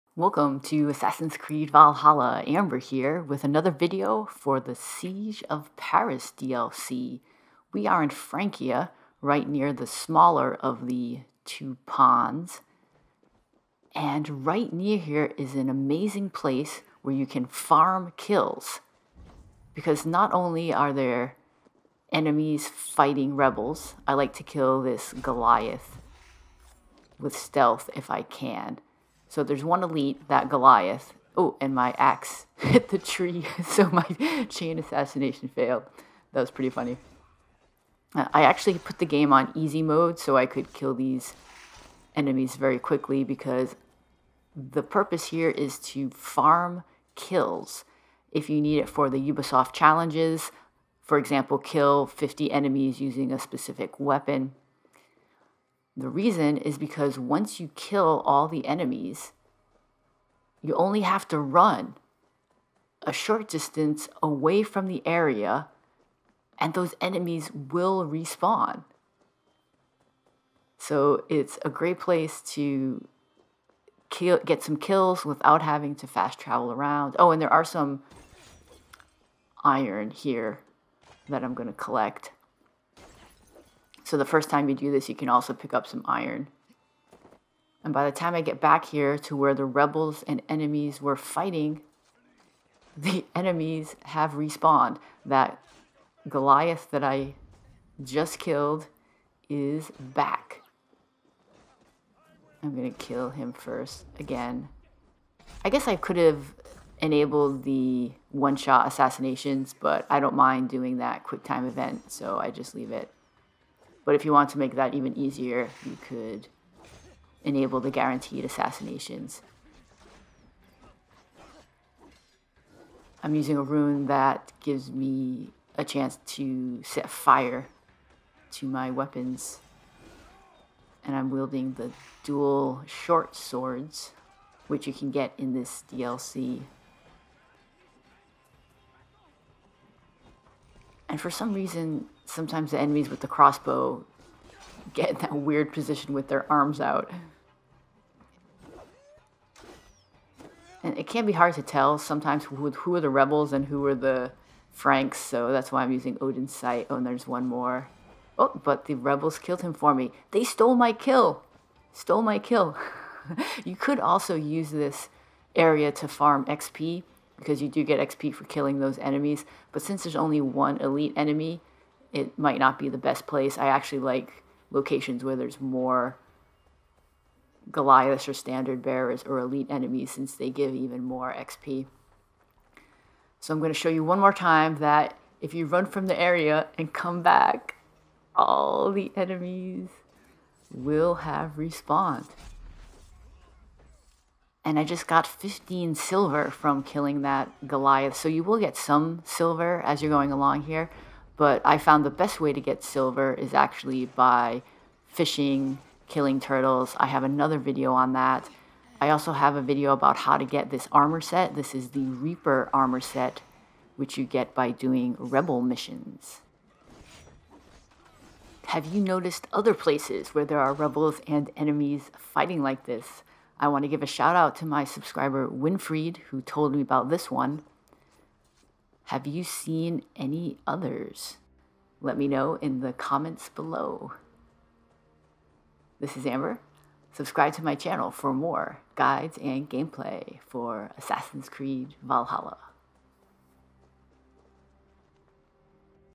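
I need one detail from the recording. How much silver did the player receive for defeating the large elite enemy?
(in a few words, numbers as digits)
15 silver.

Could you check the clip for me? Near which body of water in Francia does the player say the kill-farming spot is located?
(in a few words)
The smaller of the two ponds.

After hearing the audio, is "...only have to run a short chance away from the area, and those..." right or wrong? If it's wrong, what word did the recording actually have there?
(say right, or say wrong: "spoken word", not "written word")
wrong: "distance", not "chance".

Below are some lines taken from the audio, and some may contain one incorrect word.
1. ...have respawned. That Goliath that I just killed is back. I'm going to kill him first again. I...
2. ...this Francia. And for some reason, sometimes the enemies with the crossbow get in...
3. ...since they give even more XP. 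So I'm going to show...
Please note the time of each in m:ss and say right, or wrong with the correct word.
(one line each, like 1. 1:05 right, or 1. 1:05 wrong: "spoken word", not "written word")
1. 1:34 right
2. 2:15 wrong: "DLC", not "Francia"
3. 3:00 right.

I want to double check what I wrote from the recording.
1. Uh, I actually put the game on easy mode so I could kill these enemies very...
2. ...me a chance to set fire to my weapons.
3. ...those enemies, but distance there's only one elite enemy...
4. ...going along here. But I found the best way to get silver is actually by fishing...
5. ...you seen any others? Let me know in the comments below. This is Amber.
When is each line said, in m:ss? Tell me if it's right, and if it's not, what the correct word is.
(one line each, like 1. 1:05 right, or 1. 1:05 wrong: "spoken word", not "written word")
1. 0:38 right
2. 2:04 right
3. 2:48 wrong: "since", not "distance"
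4. 3:20 right
5. 3:49 right.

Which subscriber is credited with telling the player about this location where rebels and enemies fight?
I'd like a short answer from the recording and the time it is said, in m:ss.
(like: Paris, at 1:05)
Winfried, at 3:45.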